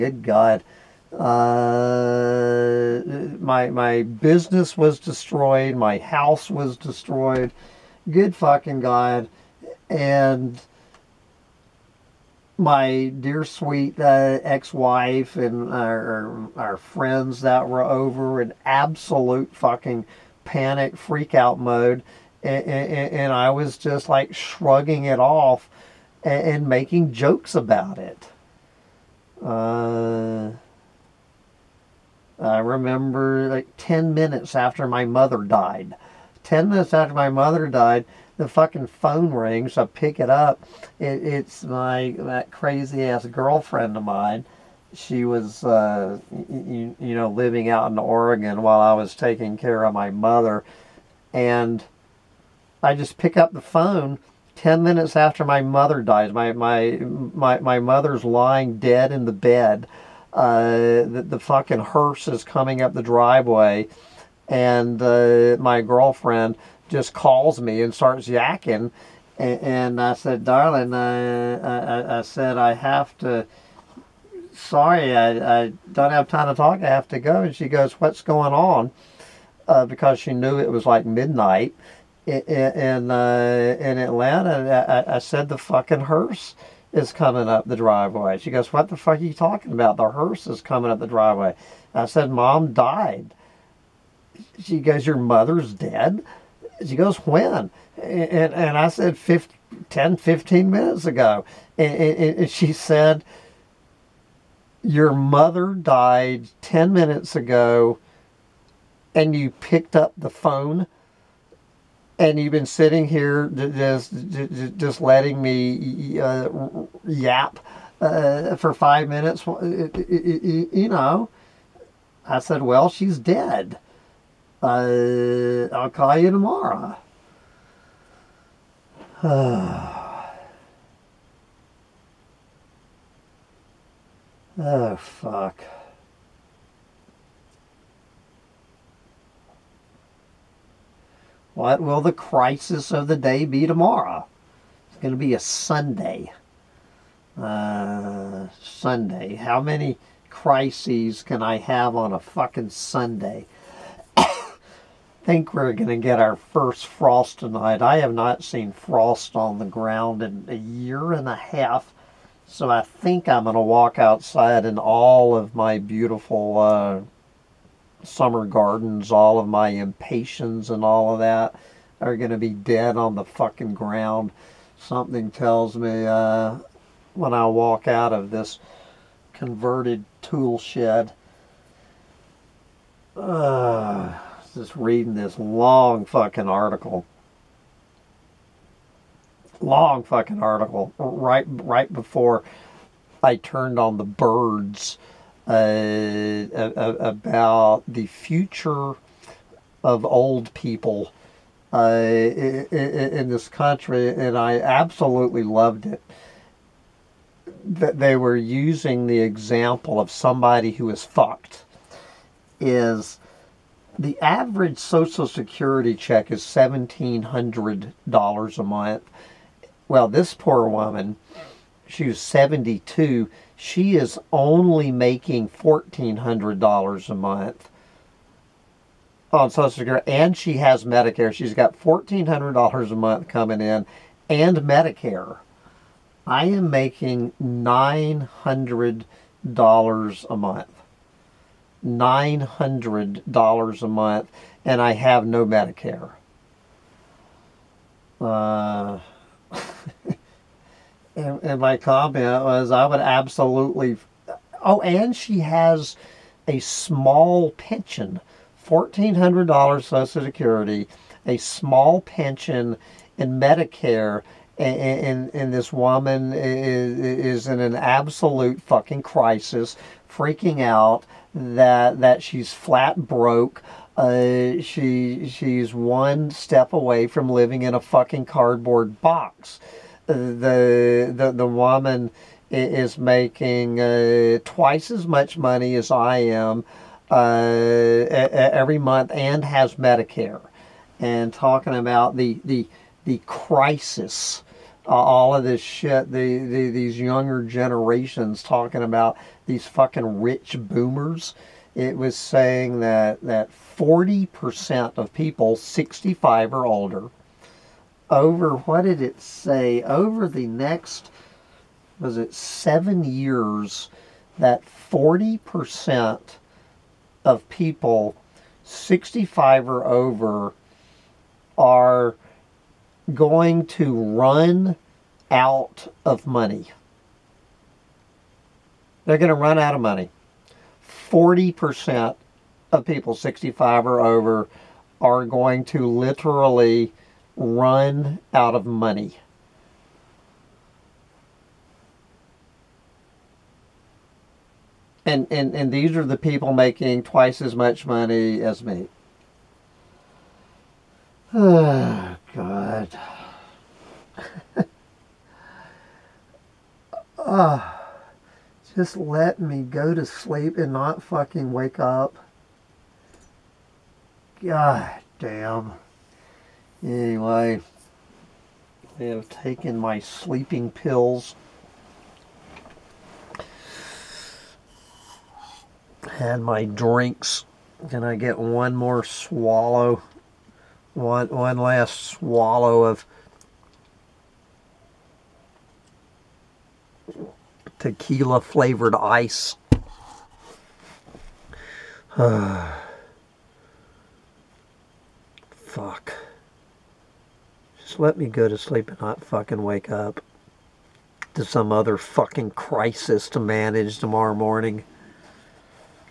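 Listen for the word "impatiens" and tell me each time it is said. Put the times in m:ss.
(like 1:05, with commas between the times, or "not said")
2:49.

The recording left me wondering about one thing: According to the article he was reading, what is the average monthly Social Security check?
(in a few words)
$1,700.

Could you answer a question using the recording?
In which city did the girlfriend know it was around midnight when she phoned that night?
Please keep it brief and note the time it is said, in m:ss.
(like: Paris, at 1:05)
Atlanta, at 1:23.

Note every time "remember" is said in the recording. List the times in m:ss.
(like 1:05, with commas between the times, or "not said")
0:32.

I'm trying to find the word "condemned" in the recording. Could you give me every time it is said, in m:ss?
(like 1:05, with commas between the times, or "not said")
not said.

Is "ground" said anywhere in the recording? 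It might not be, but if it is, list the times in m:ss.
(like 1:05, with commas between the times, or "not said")
2:39, 2:53.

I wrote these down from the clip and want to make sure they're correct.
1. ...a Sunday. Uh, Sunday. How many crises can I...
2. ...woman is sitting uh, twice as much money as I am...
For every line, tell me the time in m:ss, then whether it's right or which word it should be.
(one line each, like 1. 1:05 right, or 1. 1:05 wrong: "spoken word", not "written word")
1. 2:25 right
2. 4:41 wrong: "making", not "sitting".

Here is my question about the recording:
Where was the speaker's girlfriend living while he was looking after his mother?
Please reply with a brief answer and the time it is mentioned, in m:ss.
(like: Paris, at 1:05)
Oregon, at 0:47.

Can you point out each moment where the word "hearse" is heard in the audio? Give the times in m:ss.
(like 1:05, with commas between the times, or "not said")
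1:01, 1:26, 1:30.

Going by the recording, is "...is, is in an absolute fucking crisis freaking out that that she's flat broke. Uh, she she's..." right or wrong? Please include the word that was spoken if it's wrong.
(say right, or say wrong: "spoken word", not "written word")
right.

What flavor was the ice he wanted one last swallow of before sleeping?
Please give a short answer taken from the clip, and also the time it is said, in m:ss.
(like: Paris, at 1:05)
tequila, at 6:27.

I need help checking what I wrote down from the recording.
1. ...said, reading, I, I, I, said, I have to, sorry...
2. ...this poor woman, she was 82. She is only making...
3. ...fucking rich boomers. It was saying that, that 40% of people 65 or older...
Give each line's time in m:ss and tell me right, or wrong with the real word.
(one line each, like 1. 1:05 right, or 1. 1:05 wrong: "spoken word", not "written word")
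1. 1:10 wrong: "darling", not "reading"
2. 3:40 wrong: "72", not "82"
3. 4:59 right.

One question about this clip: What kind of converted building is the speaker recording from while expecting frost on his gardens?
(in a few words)
tool shed.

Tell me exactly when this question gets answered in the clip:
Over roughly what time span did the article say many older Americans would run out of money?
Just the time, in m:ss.
5:12.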